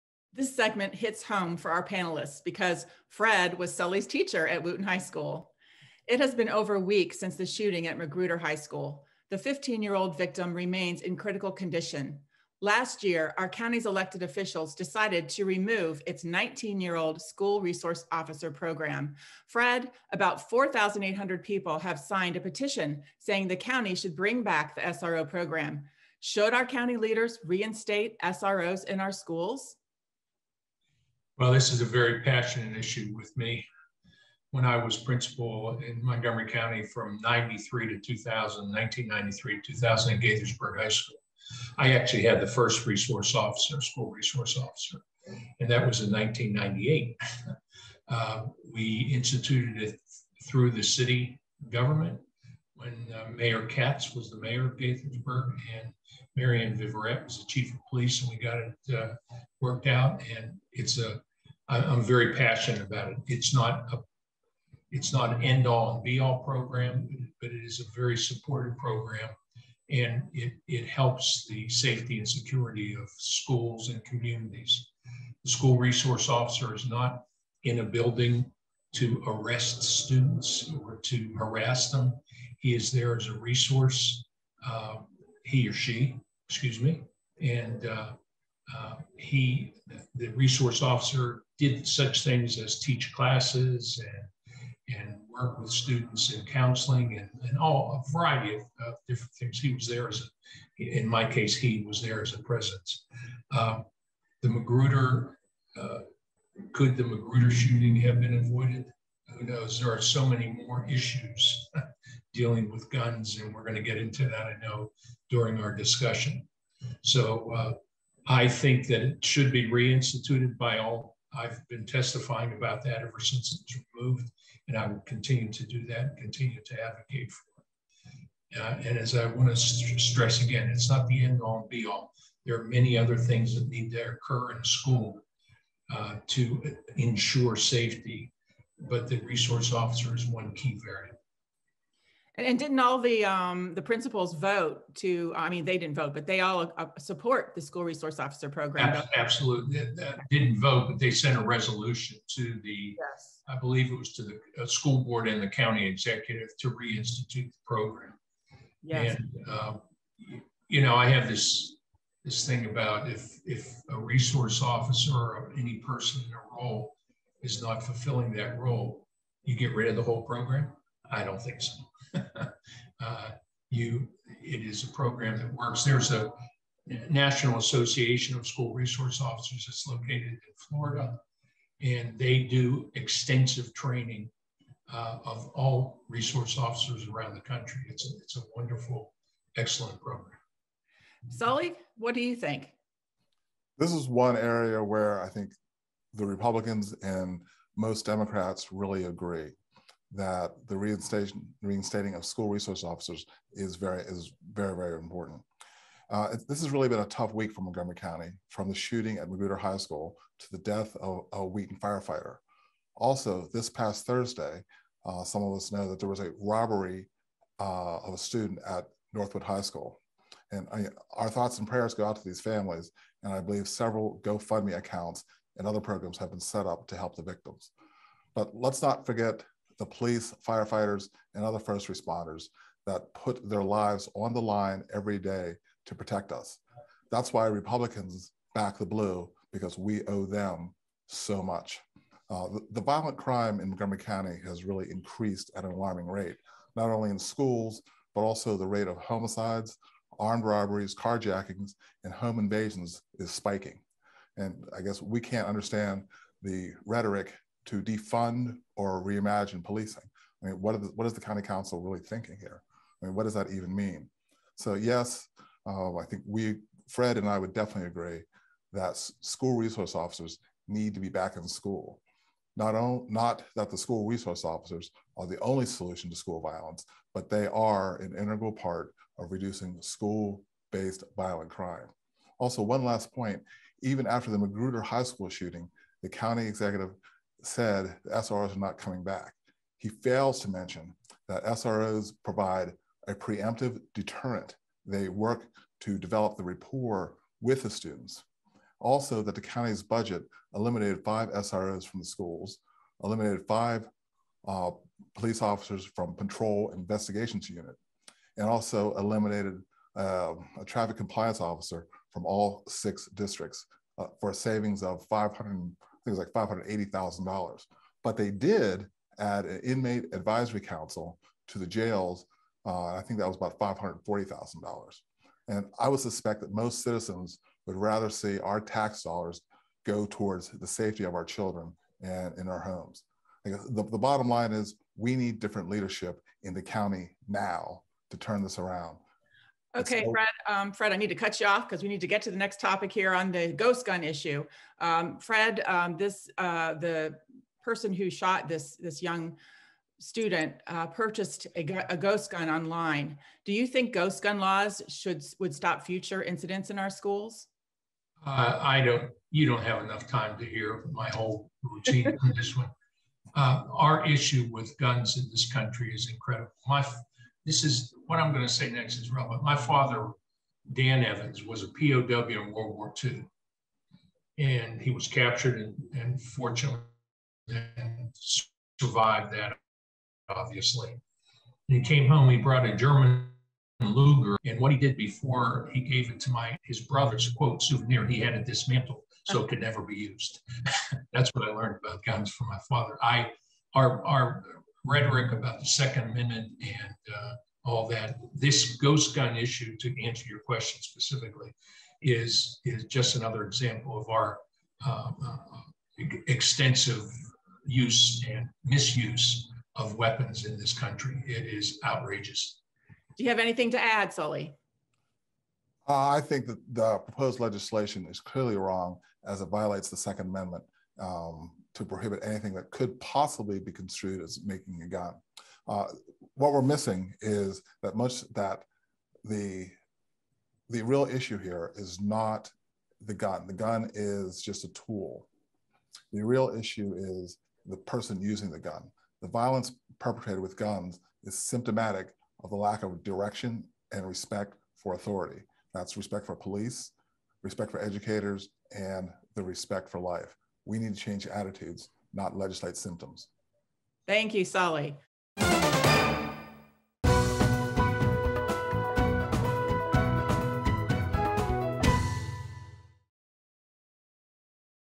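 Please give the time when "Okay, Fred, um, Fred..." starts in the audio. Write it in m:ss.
5:39.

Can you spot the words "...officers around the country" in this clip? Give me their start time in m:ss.
3:06.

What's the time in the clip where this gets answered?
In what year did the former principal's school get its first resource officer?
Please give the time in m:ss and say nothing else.
0:46.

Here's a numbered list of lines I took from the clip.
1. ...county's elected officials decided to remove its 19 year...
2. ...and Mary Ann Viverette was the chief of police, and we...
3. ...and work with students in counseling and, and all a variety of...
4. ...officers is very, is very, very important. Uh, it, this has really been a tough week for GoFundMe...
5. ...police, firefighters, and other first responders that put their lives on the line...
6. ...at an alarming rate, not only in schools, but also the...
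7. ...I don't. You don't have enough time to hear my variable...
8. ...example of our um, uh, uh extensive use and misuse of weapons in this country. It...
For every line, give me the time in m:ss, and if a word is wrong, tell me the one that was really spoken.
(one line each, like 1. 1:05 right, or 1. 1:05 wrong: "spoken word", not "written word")
1. 0:13 right
2. 0:55 right
3. 1:34 right
4. 3:22 wrong: "Montgomery", not "GoFundMe"
5. 3:49 right
6. 4:05 right
7. 5:58 wrong: "whole", not "variable"
8. 6:43 right.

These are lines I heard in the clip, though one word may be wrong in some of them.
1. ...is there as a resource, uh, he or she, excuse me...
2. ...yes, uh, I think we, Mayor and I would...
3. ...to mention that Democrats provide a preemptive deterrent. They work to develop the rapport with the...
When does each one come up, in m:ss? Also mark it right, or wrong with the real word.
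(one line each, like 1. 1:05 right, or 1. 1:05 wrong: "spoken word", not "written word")
1. 1:22 right
2. 4:24 wrong: "Fred", not "Mayor"
3. 4:50 wrong: "SROs", not "Democrats".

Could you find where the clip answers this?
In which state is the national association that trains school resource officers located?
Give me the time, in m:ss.
3:00.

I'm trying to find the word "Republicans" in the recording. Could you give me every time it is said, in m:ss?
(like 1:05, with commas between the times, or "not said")
3:16, 3:57.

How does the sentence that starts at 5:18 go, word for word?
But they did add an inmate advisory council to the jails.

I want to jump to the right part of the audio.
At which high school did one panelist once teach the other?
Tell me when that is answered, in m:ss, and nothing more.
0:04.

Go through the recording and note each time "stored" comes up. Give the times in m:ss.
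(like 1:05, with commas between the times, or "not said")
not said.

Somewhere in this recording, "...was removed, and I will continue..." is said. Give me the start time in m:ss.
2:03.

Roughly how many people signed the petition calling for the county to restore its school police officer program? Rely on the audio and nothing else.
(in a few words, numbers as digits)
4,800.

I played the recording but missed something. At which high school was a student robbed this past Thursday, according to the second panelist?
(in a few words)
Northwood High School.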